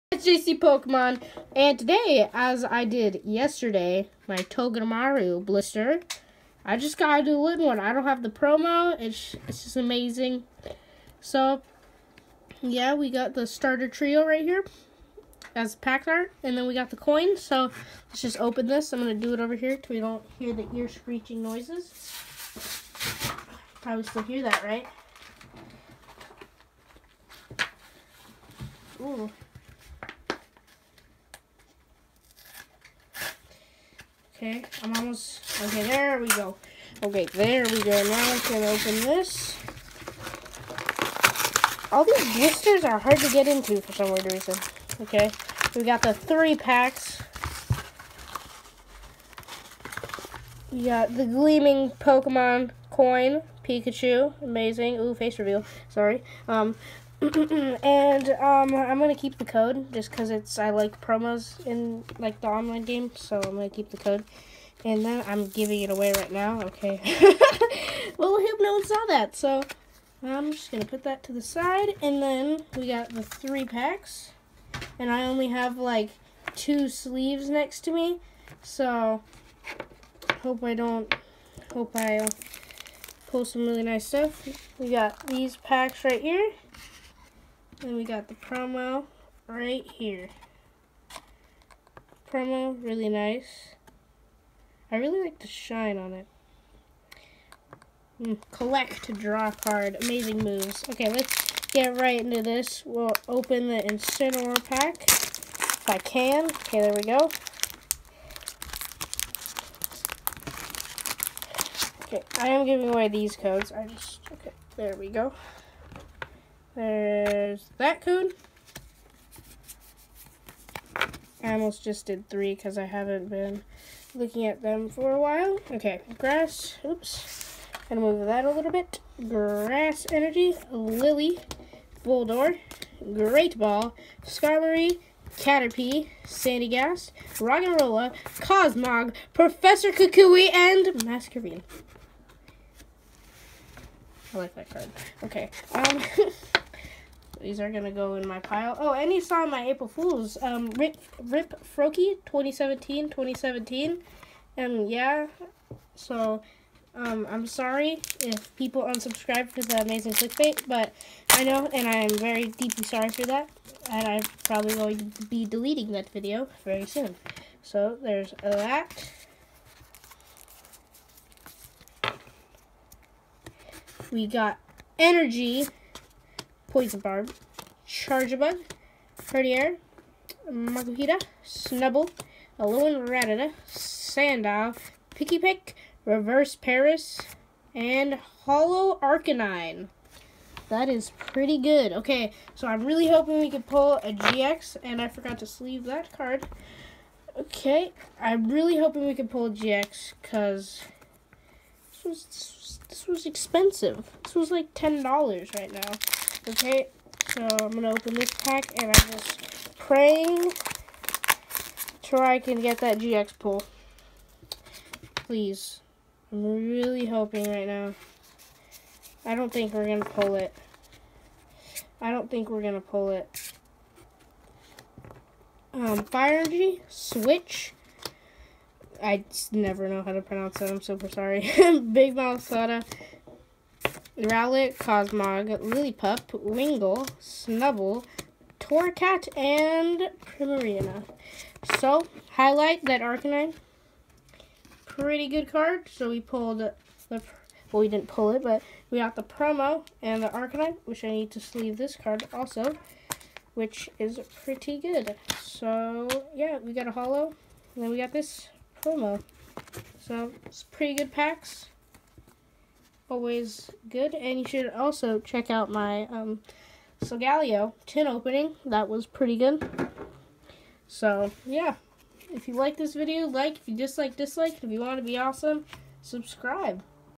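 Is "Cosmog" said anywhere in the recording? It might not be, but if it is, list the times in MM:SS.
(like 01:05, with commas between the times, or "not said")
02:18, 03:54.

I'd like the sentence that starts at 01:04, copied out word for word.
And then I'm giving it away right now.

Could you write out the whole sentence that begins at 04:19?
So, it's pretty good packs always good.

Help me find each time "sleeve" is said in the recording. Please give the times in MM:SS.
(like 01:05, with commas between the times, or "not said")
01:16, 03:15, 04:11.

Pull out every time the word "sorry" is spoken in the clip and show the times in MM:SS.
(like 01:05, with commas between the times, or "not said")
00:55, 02:37, 02:42, 03:51.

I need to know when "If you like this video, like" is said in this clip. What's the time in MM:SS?
04:32.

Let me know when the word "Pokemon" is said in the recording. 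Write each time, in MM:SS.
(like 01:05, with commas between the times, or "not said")
00:00, 00:51.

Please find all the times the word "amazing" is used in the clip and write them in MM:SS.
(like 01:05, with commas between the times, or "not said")
00:09, 00:54, 01:40, 02:39.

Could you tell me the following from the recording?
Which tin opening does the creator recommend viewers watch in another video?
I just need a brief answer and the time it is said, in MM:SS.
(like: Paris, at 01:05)
Solgaleo tin, at 04:27.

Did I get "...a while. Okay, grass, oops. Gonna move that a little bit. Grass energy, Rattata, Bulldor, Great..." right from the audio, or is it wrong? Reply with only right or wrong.
wrong.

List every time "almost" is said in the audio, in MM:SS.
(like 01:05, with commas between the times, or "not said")
00:34, 02:01.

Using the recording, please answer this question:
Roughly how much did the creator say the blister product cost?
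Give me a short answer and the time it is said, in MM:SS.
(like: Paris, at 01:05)
$10, at 03:24.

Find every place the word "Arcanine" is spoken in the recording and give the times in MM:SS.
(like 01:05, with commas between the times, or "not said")
03:09, 04:03, 04:10.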